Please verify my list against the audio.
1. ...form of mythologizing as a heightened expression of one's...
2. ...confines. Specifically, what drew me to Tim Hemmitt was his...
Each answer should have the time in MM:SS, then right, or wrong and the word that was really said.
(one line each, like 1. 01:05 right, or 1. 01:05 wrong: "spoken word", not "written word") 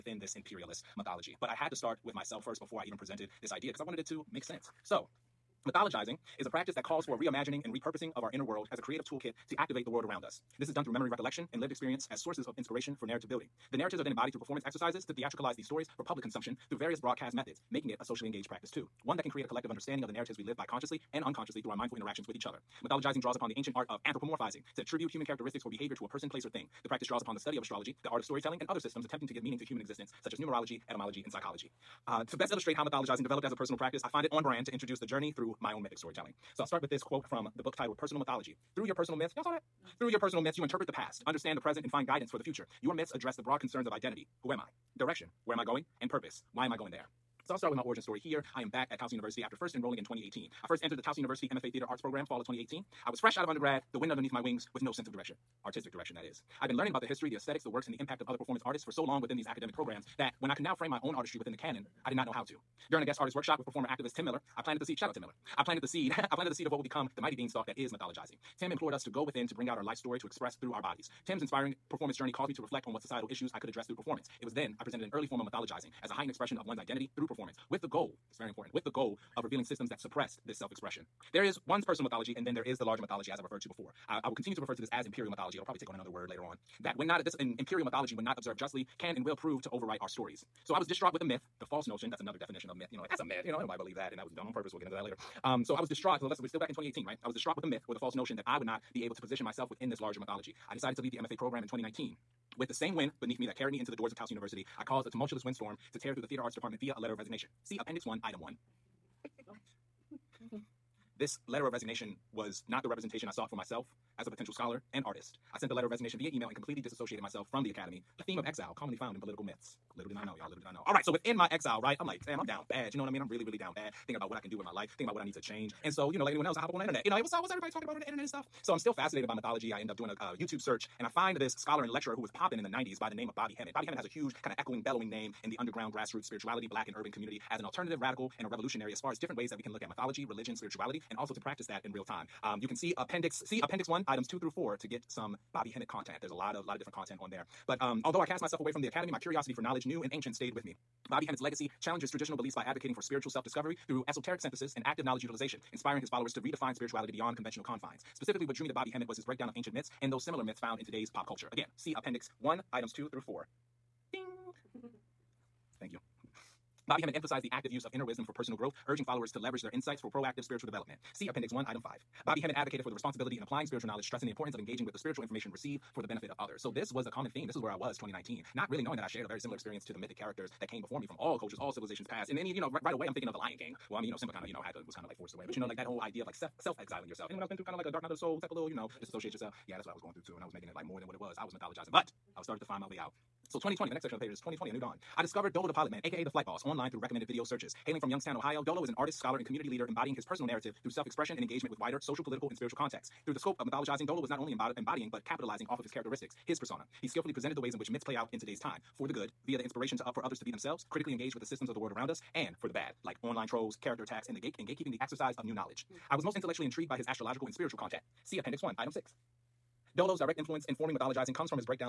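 1. 01:15 right
2. 02:37 wrong: "Bobby", not "Tim".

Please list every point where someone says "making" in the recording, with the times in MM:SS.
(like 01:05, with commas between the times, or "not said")
00:17, 03:10.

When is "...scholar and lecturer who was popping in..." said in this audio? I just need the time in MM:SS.
02:11.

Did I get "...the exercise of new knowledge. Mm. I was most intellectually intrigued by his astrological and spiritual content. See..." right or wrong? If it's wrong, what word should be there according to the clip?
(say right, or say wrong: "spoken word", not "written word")
right.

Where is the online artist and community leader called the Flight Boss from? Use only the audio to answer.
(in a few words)
Youngstown, Ohio.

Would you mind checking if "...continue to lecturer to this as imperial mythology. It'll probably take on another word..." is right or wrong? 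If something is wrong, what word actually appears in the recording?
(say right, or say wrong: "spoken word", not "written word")
wrong: "refer", not "lecturer".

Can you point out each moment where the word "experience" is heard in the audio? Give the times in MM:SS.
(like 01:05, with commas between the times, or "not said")
00:11, 02:59.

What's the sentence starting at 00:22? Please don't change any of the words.
Mythologizing draws upon the ancient art of anthropomorphizing to attribute human characteristics or behavior to a person, place, or thing.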